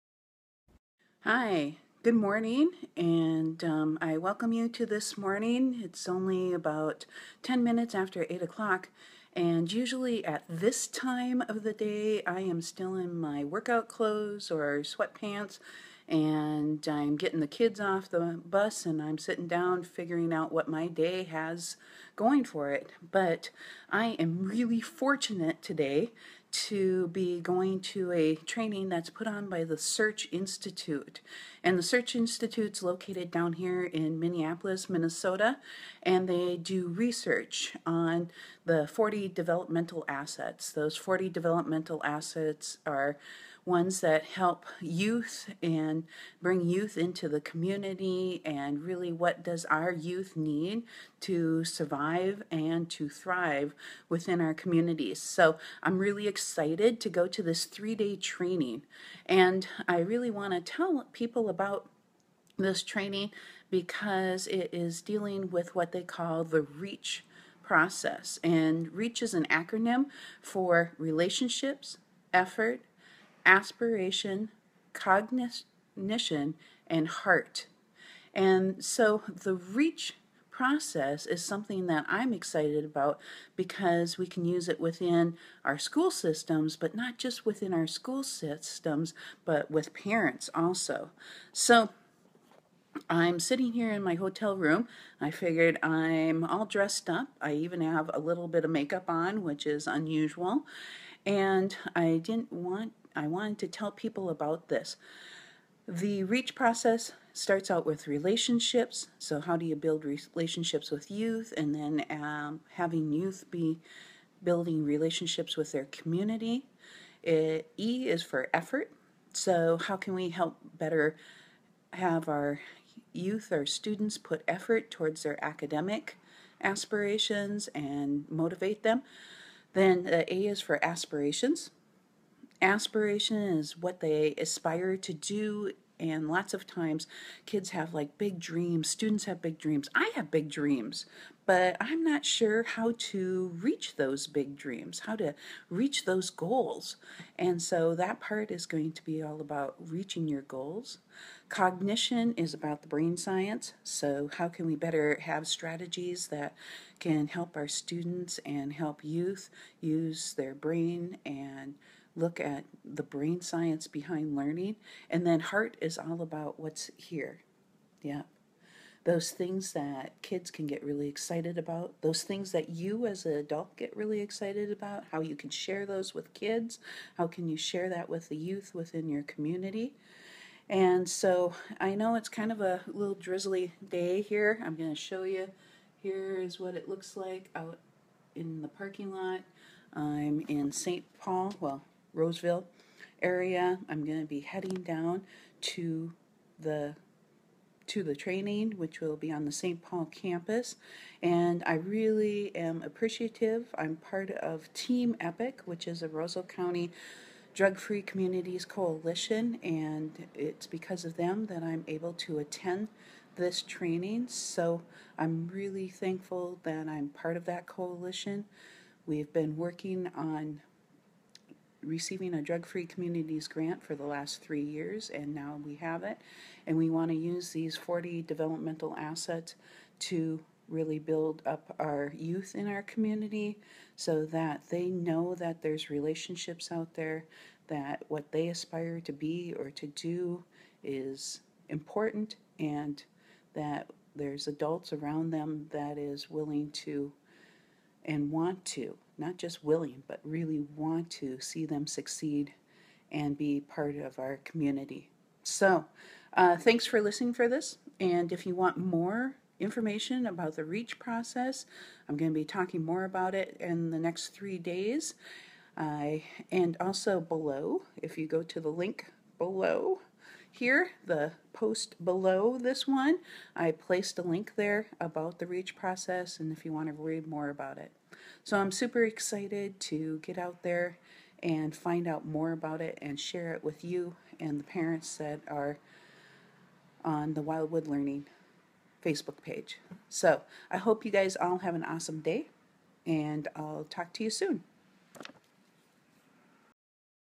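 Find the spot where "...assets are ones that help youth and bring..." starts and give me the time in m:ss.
0:42.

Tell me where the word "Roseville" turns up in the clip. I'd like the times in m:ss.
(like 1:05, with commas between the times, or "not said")
3:12, 3:26.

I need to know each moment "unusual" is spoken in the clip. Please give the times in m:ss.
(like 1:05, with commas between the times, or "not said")
1:39.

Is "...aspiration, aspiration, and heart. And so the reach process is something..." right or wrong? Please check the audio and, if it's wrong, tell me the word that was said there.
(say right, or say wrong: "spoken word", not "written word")
wrong: "cognition", not "aspiration".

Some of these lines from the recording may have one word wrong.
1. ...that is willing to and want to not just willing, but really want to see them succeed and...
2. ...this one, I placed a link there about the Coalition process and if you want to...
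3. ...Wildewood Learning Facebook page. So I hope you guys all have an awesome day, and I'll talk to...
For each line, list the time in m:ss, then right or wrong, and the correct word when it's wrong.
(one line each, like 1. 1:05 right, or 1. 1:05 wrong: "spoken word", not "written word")
1. 4:05 right
2. 4:32 wrong: "REACH", not "Coalition"
3. 4:47 right.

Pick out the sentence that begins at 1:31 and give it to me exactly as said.
So I'm sitting here in my hotel room.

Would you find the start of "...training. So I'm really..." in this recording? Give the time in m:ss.
3:33.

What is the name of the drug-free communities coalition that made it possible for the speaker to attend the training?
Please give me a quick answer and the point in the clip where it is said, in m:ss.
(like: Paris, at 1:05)
Team EPIC, at 3:24.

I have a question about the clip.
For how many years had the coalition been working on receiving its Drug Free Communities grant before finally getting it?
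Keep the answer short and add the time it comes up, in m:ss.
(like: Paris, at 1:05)
3, at 3:44.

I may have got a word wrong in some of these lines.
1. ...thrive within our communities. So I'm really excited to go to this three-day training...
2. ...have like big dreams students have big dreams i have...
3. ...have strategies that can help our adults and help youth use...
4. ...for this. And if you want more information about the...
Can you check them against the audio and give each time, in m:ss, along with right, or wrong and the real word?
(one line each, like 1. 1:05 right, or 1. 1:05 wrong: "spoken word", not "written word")
1. 0:53 right
2. 2:17 right
3. 2:35 wrong: "students", not "adults"
4. 4:17 right.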